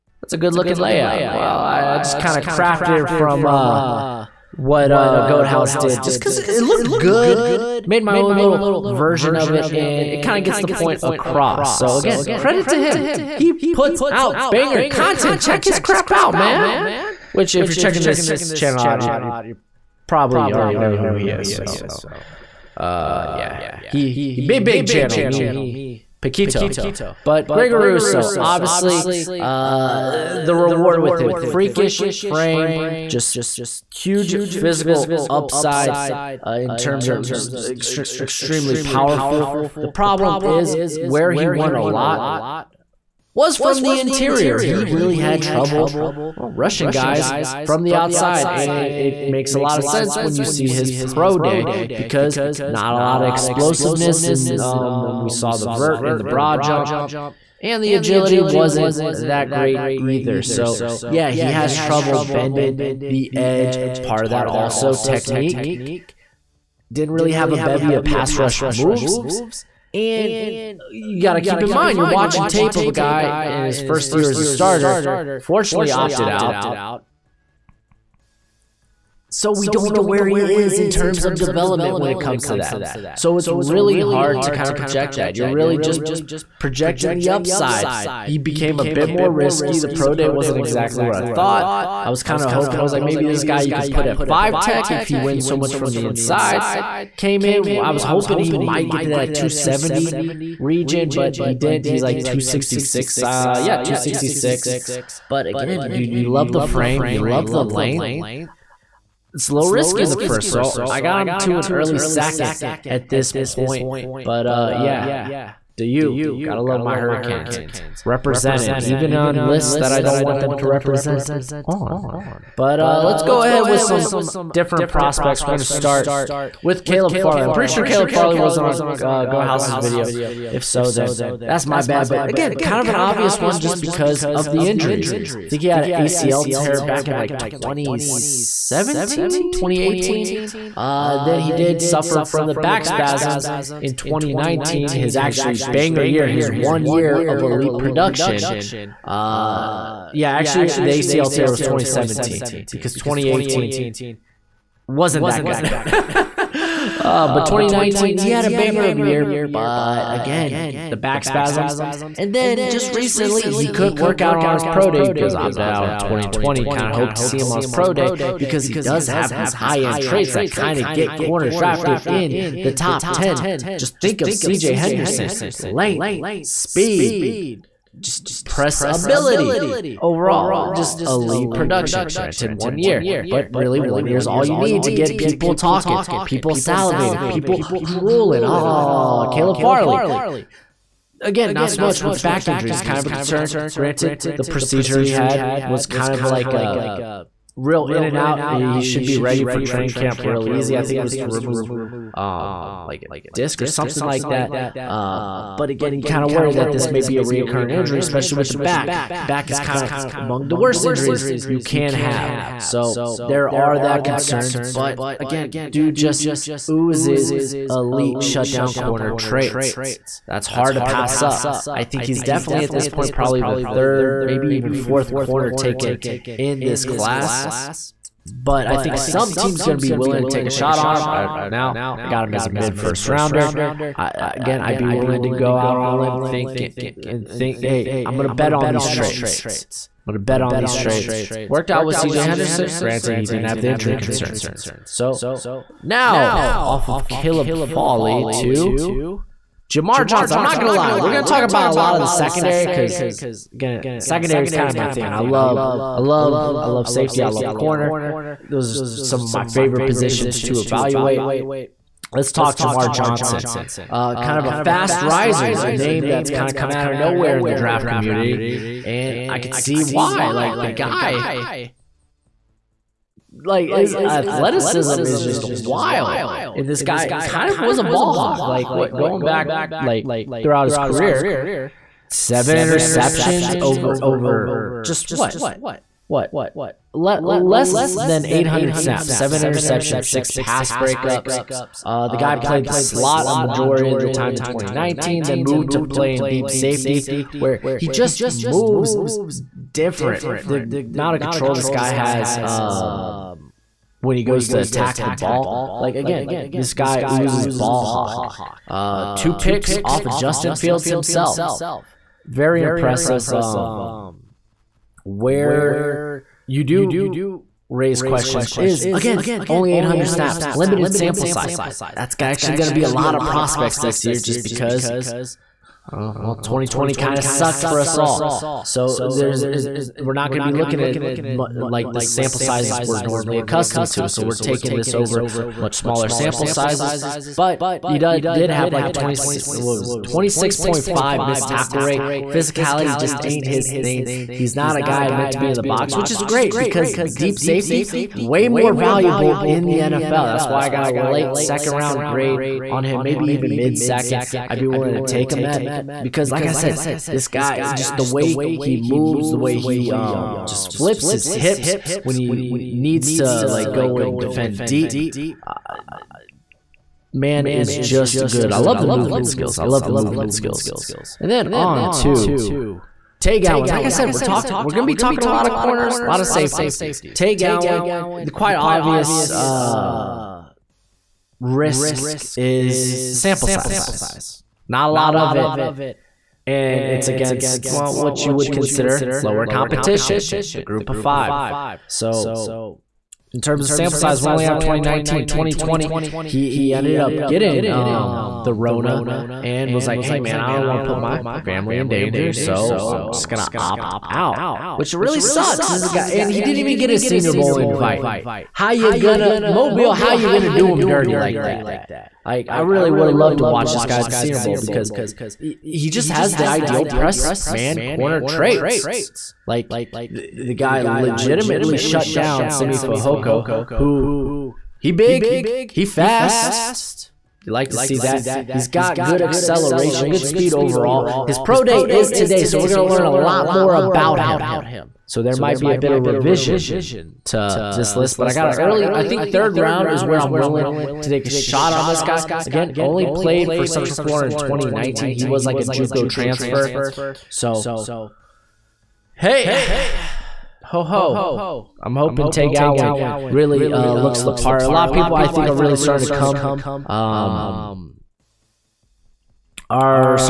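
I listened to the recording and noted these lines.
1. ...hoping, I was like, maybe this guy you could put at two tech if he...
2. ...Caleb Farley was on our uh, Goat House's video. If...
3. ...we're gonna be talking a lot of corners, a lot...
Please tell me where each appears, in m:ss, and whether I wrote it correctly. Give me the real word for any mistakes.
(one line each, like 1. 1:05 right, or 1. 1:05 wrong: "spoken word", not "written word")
1. 1:32 wrong: "five", not "two"
2. 2:07 right
3. 6:14 right.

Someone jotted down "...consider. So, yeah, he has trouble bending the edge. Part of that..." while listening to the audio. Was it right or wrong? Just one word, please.
wrong.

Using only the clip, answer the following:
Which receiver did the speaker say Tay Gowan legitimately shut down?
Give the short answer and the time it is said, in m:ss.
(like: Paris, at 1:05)
Simi Fehoko, at 7:02.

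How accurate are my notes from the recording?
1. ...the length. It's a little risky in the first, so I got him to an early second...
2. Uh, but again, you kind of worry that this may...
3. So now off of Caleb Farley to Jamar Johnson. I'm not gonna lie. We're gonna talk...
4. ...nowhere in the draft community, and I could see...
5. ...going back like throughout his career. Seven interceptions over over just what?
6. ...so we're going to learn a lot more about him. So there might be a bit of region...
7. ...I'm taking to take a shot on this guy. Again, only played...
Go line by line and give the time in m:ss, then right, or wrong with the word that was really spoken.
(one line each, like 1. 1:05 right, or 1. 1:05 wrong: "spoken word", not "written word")
1. 1:47 right
2. 3:24 right
3. 4:04 right
4. 4:26 right
5. 4:38 right
6. 7:12 wrong: "revision", not "region"
7. 7:20 wrong: "willing", not "taking".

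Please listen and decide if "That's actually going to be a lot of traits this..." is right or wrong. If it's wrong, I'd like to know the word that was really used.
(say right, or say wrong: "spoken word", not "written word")
wrong: "prospects", not "traits".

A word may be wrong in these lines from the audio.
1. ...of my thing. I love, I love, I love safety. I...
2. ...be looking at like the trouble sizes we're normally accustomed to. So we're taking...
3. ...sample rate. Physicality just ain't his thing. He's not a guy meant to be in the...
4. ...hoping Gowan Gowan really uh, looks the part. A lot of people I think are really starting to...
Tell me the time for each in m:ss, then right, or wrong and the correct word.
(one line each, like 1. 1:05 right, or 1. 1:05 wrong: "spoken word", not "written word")
1. 4:14 right
2. 5:30 wrong: "sample", not "trouble"
3. 5:41 wrong: "tackle", not "sample"
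4. 7:31 wrong: "Tay", not "Gowan".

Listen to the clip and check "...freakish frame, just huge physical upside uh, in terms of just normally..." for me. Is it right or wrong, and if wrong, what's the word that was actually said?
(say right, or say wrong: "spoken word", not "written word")
wrong: "extremely", not "normally".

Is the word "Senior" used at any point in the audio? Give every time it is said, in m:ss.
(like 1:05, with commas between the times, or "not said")
6:46, 6:54.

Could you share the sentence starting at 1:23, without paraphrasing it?
So it's really hard to kind of project that.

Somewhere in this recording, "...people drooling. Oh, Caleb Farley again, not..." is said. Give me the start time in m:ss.
3:07.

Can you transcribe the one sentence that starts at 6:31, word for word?
So in terms of sample size, we only have 2019.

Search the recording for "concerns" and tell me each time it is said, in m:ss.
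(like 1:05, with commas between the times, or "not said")
3:13, 3:34, 4:03.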